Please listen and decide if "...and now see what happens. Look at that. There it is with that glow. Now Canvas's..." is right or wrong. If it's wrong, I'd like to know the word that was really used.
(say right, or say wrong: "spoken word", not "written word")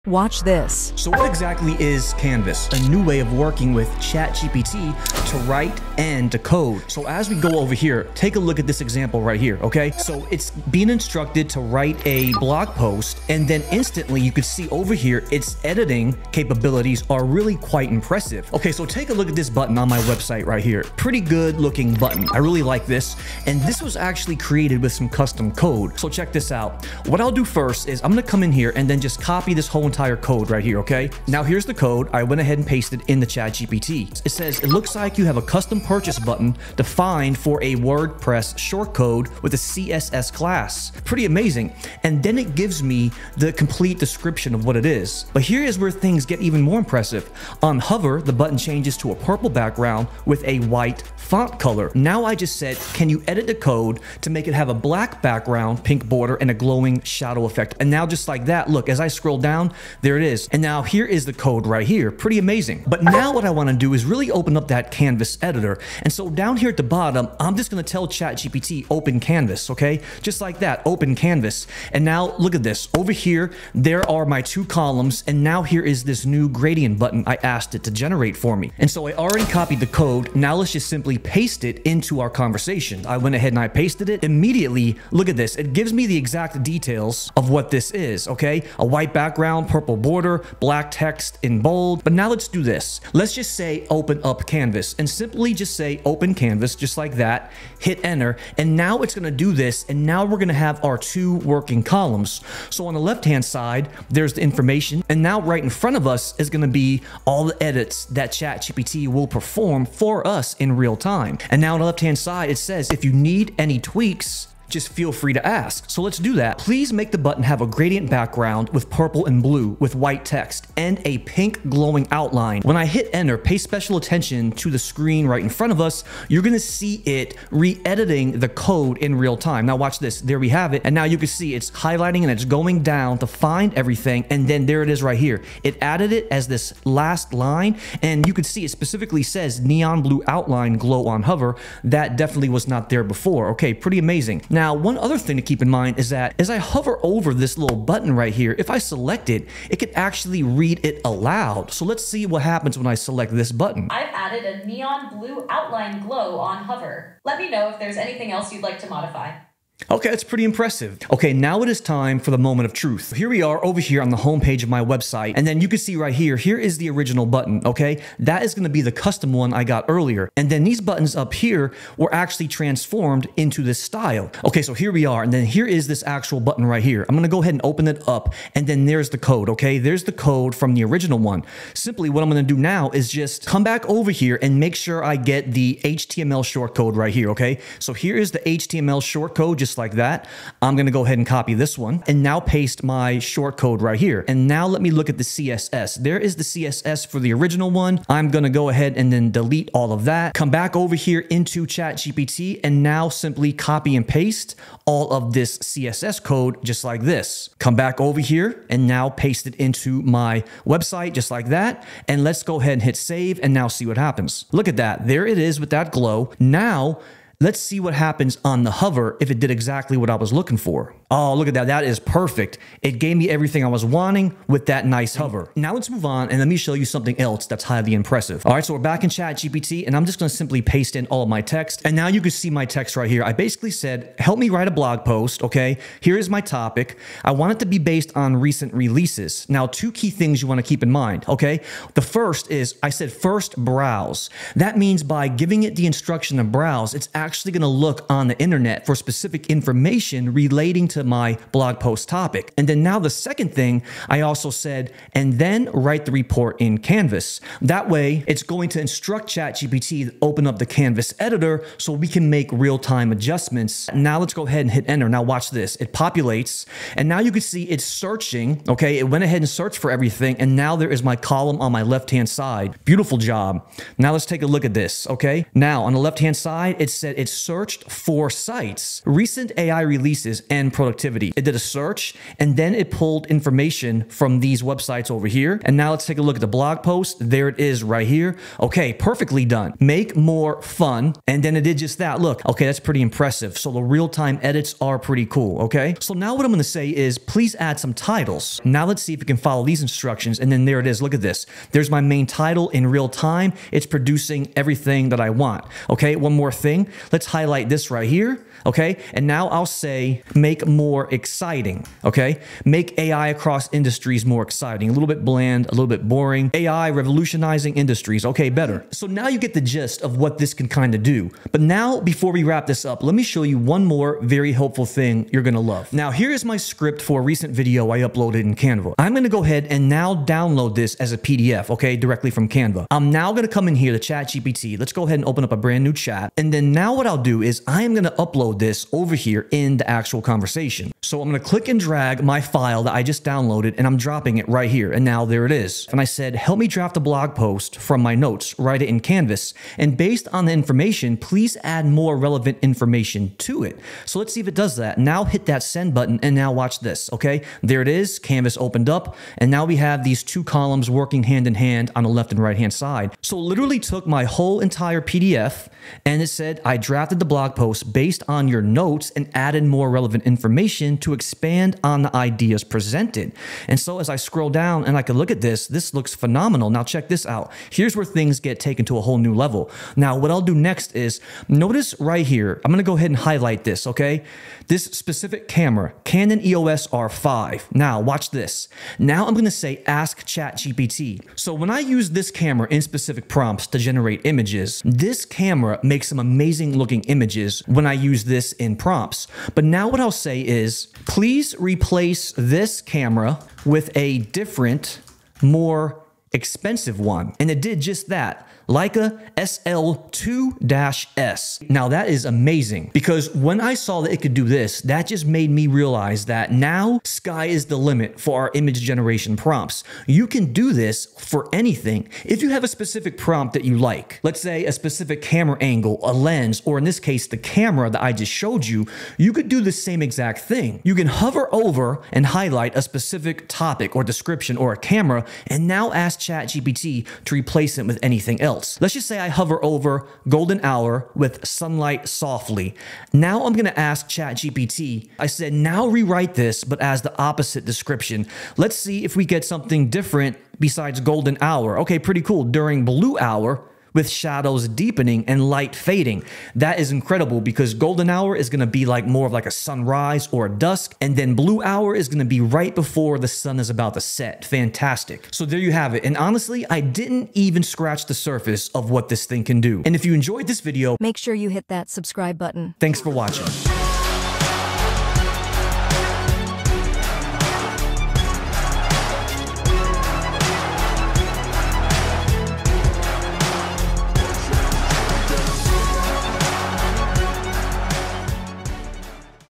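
wrong: "Let", not "Canvas".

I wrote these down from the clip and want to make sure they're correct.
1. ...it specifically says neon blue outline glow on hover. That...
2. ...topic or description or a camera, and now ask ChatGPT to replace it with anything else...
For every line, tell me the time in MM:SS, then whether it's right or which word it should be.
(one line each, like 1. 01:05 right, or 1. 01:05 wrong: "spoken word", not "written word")
1. 02:18 right
2. 07:13 right.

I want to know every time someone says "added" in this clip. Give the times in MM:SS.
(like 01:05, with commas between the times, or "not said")
02:15, 02:34, 06:09.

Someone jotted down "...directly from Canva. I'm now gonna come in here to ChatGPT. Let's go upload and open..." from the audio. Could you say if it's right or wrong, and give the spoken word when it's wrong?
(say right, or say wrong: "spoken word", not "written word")
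wrong: "ahead", not "upload".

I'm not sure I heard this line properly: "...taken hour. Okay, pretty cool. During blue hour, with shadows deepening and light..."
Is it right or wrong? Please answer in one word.
wrong.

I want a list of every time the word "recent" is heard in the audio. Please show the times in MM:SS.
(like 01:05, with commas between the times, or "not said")
03:58, 04:39, 05:27.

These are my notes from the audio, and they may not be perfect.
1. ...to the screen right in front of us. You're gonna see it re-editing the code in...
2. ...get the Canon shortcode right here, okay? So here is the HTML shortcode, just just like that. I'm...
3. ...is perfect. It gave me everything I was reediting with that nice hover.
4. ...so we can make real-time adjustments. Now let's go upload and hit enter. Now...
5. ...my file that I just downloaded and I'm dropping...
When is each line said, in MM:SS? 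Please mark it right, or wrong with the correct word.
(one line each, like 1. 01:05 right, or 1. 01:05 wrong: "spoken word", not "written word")
1. 02:04 right
2. 03:05 wrong: "HTML", not "Canon"
3. 03:41 wrong: "wanting", not "reediting"
4. 04:21 wrong: "ahead", not "upload"
5. 05:42 right.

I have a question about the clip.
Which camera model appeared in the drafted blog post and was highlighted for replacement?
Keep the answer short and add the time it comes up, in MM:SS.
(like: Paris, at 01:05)
Canon EOS R5, at 06:26.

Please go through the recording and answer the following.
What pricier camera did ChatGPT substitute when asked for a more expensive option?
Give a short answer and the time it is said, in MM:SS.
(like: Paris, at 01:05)
Leica SL2-S, at 06:48.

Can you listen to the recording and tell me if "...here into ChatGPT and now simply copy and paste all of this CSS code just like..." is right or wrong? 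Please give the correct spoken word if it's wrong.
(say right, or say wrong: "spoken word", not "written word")
right.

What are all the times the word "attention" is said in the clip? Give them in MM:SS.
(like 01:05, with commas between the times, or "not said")
02:03.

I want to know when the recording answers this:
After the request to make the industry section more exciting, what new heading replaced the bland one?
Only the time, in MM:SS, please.
05:16.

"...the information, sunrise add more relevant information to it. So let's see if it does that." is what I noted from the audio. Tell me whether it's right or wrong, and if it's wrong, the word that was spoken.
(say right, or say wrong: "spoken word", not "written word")
wrong: "please", not "sunrise".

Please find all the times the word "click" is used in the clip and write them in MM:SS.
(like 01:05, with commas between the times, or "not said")
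05:41.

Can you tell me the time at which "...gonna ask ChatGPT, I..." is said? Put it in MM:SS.
07:23.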